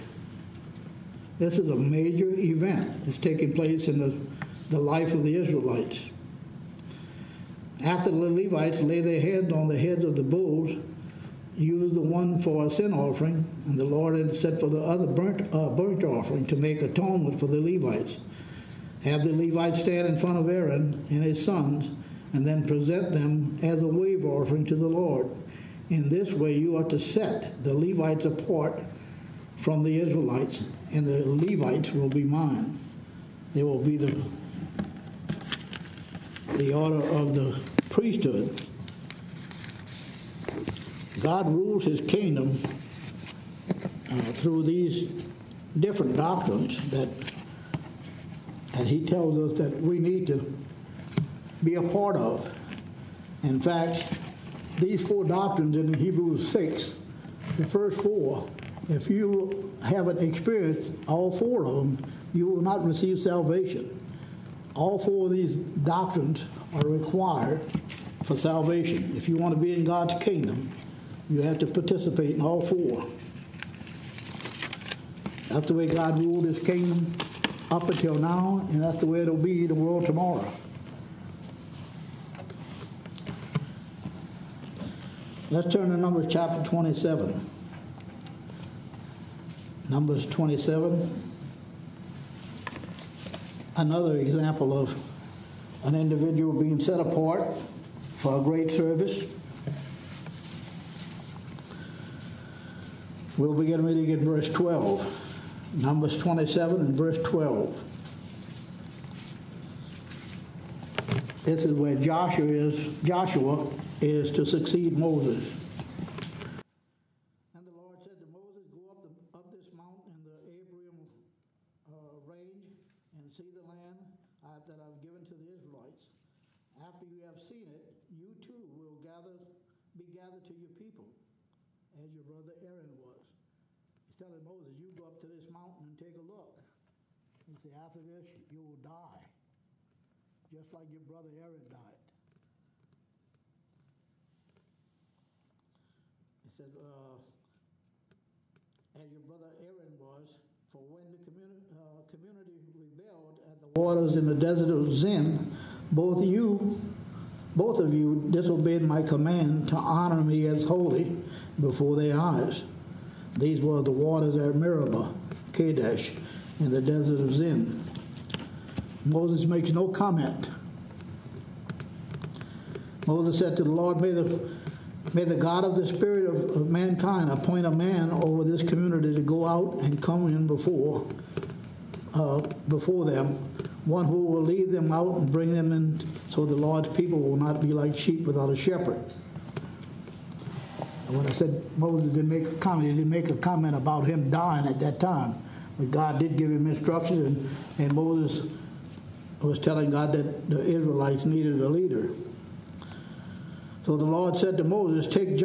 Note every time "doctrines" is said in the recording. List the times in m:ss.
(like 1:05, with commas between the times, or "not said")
0:46, 0:55, 1:05.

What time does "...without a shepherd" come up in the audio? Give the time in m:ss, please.
3:08.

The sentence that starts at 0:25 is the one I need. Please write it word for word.
In this way, you are to set the Levites apart from the Israelites, and the Levites will be mine.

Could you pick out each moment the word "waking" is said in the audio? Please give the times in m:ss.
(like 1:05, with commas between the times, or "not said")
not said.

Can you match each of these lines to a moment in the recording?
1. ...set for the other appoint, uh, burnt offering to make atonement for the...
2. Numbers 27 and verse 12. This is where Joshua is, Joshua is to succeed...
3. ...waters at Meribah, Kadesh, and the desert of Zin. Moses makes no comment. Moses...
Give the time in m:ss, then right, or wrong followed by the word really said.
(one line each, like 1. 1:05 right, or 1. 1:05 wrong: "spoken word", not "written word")
1. 0:14 wrong: "burnt", not "appoint"
2. 1:45 right
3. 2:43 right.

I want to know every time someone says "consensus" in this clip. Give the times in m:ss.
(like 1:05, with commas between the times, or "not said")
not said.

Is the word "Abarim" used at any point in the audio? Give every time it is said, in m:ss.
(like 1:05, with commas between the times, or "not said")
2:00.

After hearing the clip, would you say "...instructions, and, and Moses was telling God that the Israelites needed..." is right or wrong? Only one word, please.
right.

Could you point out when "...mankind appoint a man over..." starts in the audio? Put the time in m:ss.
2:56.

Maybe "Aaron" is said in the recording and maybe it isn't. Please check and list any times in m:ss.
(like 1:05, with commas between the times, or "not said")
0:20, 2:12, 2:21, 2:29.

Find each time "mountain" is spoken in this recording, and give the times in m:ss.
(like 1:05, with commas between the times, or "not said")
1:59, 2:15.